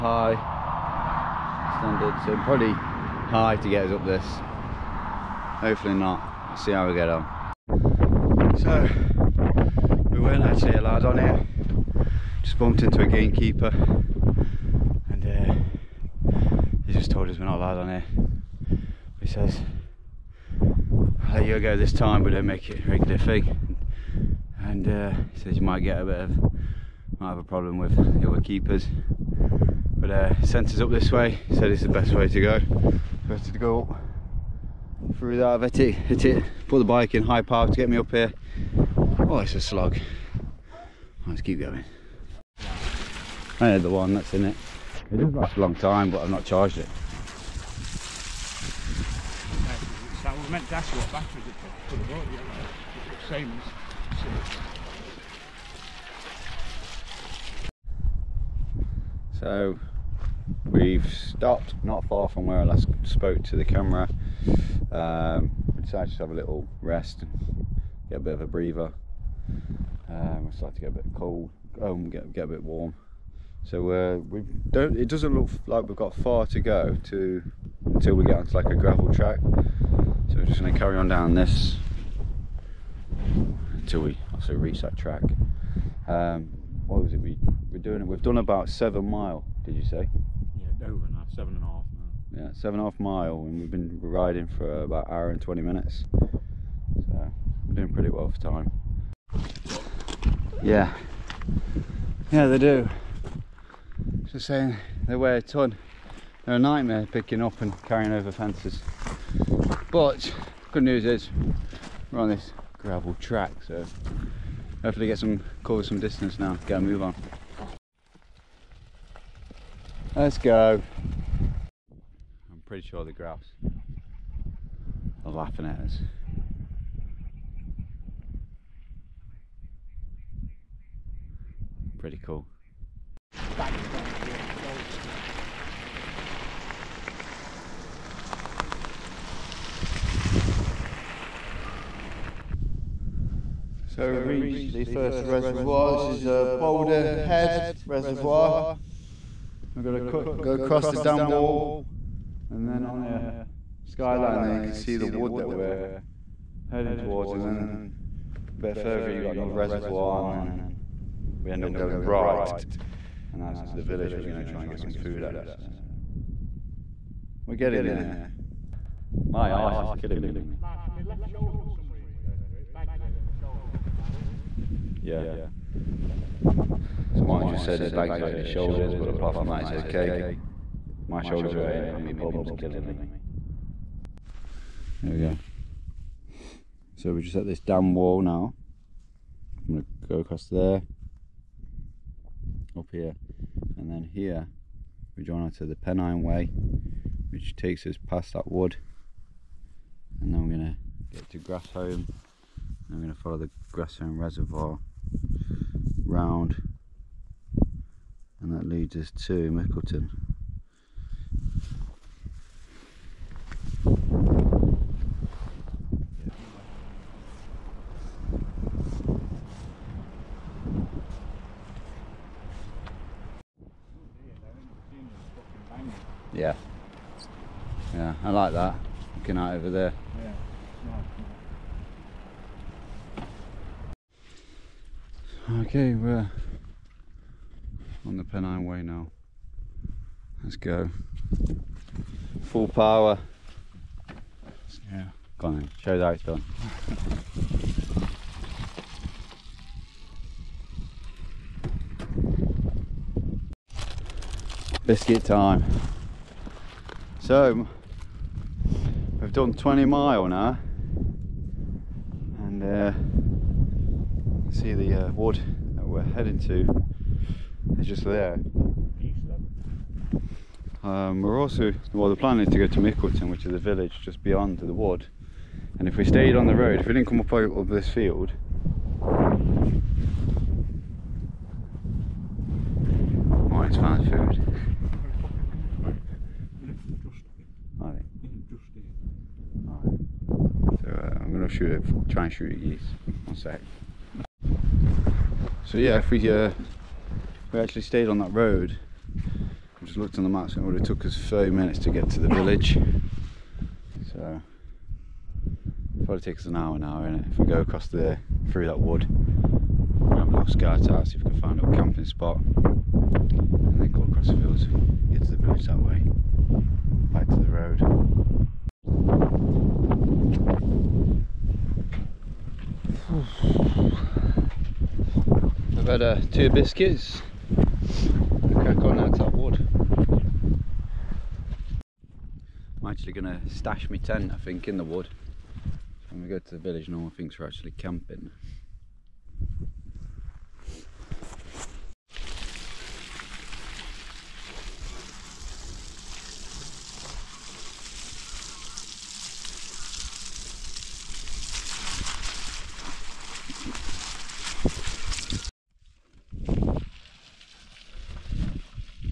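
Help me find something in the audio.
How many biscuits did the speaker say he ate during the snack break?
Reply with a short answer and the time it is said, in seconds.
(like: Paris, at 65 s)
2, at 326 s.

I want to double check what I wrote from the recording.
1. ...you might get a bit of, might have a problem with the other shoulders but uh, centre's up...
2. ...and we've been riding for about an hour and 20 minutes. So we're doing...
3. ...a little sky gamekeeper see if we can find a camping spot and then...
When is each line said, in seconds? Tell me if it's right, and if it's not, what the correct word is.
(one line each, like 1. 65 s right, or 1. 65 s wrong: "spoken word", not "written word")
1. 25 s wrong: "keepers", not "shoulders"
2. 93 s right
3. 310 s wrong: "tower", not "gamekeeper".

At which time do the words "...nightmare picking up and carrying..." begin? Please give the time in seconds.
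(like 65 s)
106 s.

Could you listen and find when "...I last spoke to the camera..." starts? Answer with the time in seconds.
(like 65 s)
62 s.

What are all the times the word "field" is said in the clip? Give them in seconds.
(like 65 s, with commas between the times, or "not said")
277 s, 314 s.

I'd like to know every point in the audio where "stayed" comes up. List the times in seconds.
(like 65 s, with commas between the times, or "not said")
276 s, 297 s.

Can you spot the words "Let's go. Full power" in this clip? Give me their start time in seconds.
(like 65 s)
240 s.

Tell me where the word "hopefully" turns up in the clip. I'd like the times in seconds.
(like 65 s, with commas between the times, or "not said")
5 s, 114 s.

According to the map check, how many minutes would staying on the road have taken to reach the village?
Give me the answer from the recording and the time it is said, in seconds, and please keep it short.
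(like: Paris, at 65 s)
30, at 301 s.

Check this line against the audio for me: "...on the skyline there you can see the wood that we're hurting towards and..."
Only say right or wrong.
wrong.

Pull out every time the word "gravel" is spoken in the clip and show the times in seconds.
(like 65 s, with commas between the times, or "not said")
78 s, 112 s.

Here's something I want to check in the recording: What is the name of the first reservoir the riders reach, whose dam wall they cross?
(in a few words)
Boulder Head Reservoir.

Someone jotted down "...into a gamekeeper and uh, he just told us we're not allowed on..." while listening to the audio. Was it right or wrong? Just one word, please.
right.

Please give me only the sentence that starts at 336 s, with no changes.
when we go to the village, no one thinks we're actually camping.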